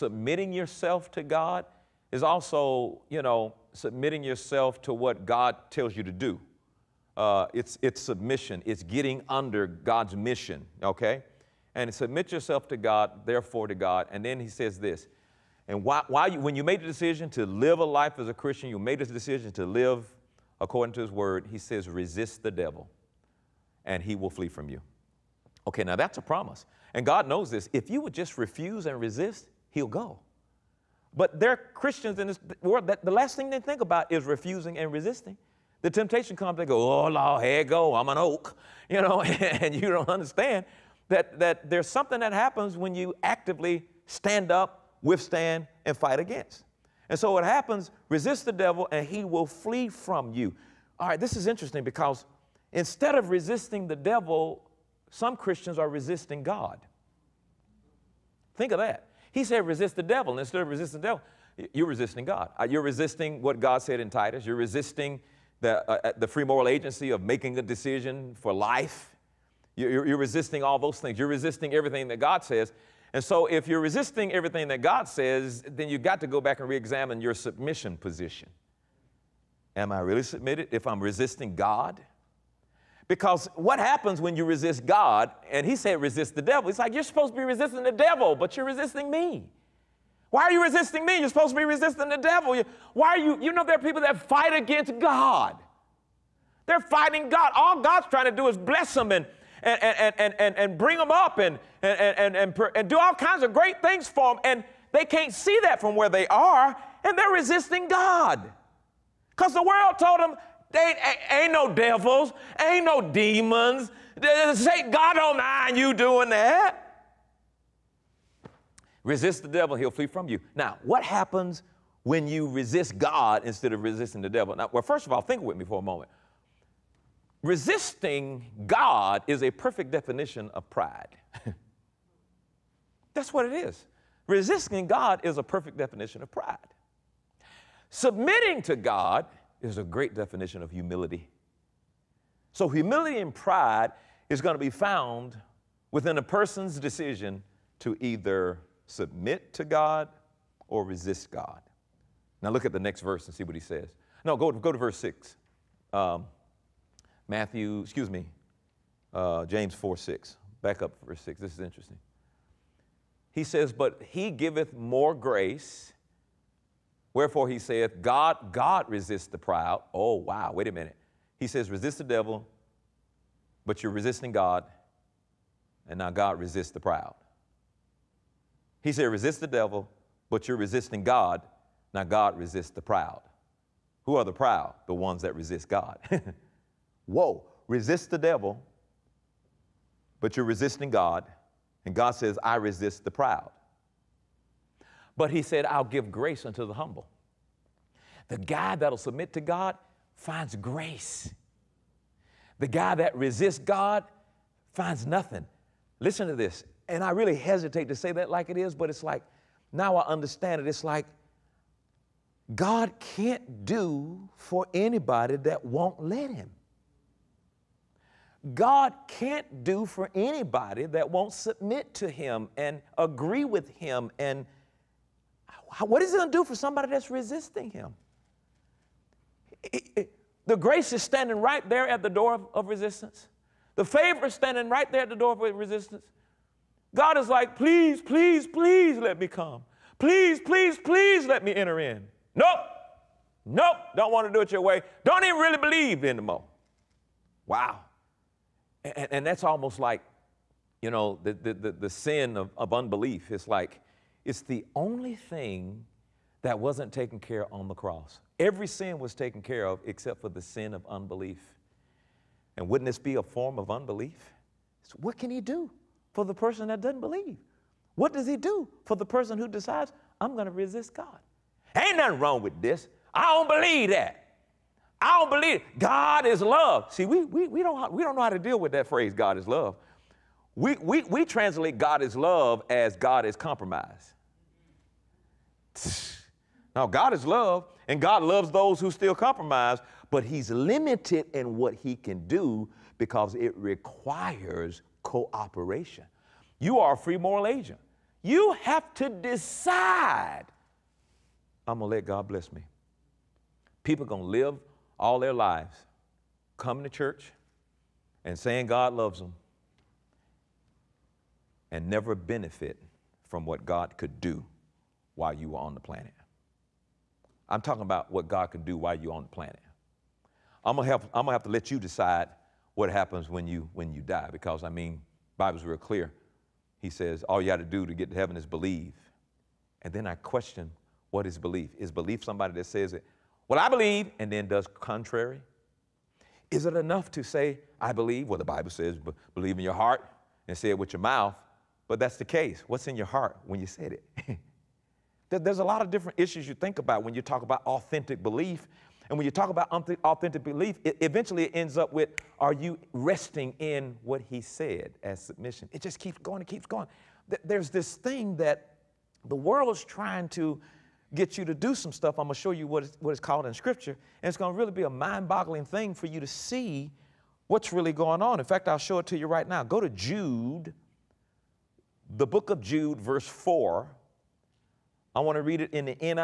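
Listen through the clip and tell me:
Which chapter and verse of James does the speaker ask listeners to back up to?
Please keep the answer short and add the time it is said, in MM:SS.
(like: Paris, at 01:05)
James 4:6, at 02:39.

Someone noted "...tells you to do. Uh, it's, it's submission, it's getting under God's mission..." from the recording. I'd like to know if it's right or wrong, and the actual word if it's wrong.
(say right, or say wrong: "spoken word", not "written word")
right.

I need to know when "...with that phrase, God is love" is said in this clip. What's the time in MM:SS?
04:38.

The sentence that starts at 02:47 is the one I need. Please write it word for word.
Wherefore he saith, God, God resists the proud.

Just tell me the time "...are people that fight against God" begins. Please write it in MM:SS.
01:33.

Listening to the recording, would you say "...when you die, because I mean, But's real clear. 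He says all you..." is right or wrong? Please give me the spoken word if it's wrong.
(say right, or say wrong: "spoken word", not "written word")
wrong: "Bible", not "But".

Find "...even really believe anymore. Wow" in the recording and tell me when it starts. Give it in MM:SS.
04:05.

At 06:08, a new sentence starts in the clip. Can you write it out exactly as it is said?
In fact, I'll show it to you right now.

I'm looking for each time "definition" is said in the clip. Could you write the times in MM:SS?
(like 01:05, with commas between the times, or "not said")
02:09, 02:15, 02:20.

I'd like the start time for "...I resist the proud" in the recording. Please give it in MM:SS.
03:12.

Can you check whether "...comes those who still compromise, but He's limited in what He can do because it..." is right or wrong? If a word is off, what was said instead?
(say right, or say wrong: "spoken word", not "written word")
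wrong: "loves", not "comes".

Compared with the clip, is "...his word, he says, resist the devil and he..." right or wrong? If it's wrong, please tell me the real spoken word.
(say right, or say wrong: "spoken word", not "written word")
right.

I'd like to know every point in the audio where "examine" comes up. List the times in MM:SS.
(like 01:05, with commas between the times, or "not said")
01:16.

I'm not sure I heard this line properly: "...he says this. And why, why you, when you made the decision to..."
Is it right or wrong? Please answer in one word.
right.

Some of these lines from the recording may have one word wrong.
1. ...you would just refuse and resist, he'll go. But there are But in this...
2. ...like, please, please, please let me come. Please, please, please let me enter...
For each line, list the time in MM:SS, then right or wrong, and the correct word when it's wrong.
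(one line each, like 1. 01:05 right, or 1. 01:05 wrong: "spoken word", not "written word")
1. 00:27 wrong: "Christians", not "But"
2. 03:57 right.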